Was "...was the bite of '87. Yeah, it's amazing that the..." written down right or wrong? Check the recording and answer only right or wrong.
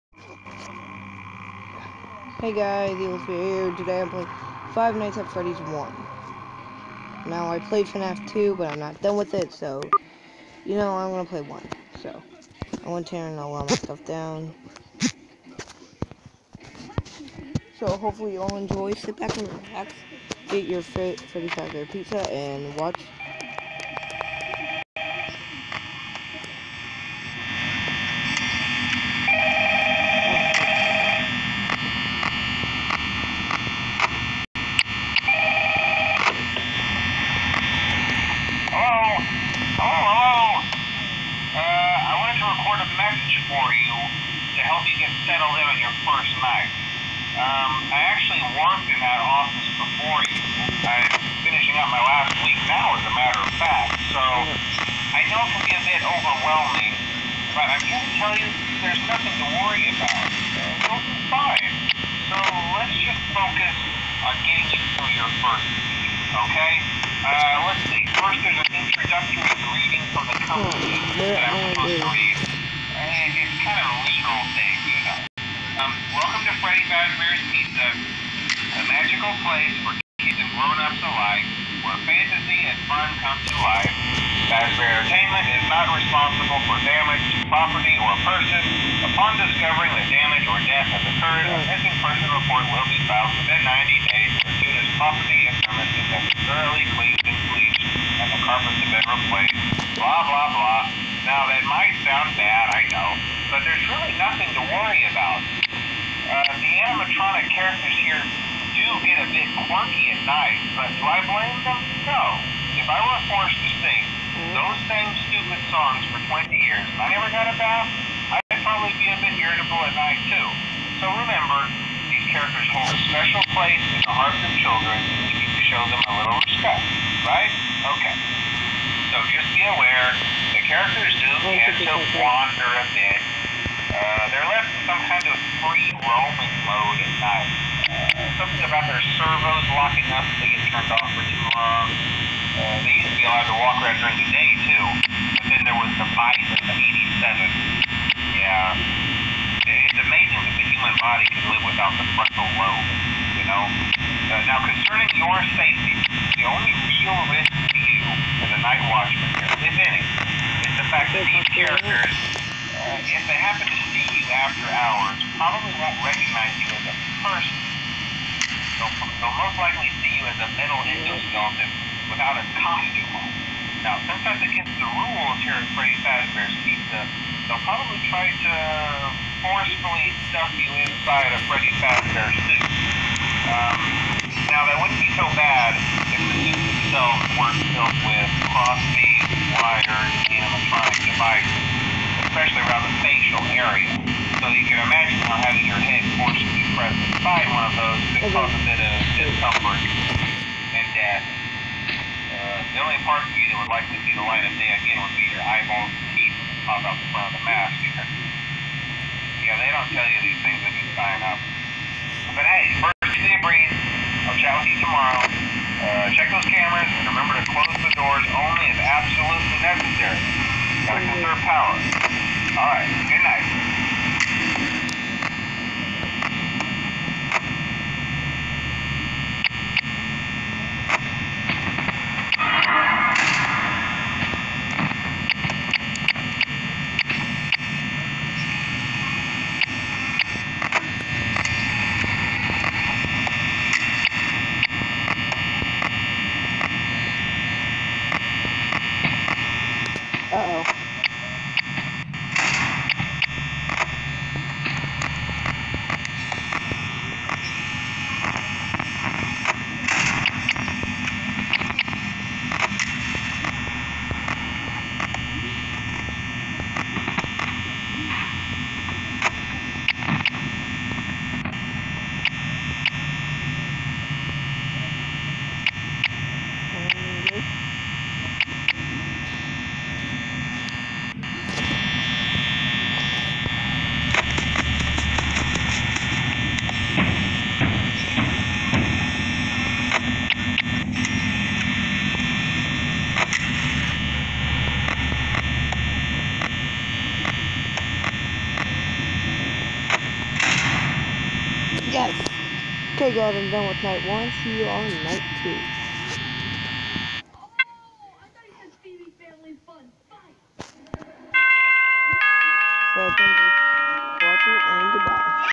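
right.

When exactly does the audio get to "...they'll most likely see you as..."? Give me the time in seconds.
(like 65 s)
169 s.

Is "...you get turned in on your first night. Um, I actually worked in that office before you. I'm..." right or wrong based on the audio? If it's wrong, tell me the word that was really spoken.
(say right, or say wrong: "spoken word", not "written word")
wrong: "settled", not "turned".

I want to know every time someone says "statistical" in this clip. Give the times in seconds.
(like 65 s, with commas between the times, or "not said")
not said.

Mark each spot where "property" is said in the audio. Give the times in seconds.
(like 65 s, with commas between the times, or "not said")
87 s, 94 s.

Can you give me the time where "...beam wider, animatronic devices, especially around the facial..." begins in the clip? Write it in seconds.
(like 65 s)
188 s.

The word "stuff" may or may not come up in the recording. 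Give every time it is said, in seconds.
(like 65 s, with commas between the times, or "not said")
13 s, 180 s.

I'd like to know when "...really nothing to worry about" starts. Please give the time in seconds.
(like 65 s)
103 s.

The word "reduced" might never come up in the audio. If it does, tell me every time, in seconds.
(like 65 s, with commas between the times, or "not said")
not said.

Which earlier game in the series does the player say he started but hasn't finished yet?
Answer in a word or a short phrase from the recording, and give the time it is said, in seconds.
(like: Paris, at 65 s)
FNAF 2, at 7 s.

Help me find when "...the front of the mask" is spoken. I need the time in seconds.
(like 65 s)
206 s.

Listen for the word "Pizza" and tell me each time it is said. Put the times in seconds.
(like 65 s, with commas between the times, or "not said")
21 s, 76 s, 176 s.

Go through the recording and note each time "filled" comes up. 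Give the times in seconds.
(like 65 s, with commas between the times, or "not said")
187 s.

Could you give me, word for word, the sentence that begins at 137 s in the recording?
Uh, something about their servos locking up if they get turned off for too long.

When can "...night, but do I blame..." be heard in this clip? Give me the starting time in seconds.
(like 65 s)
110 s.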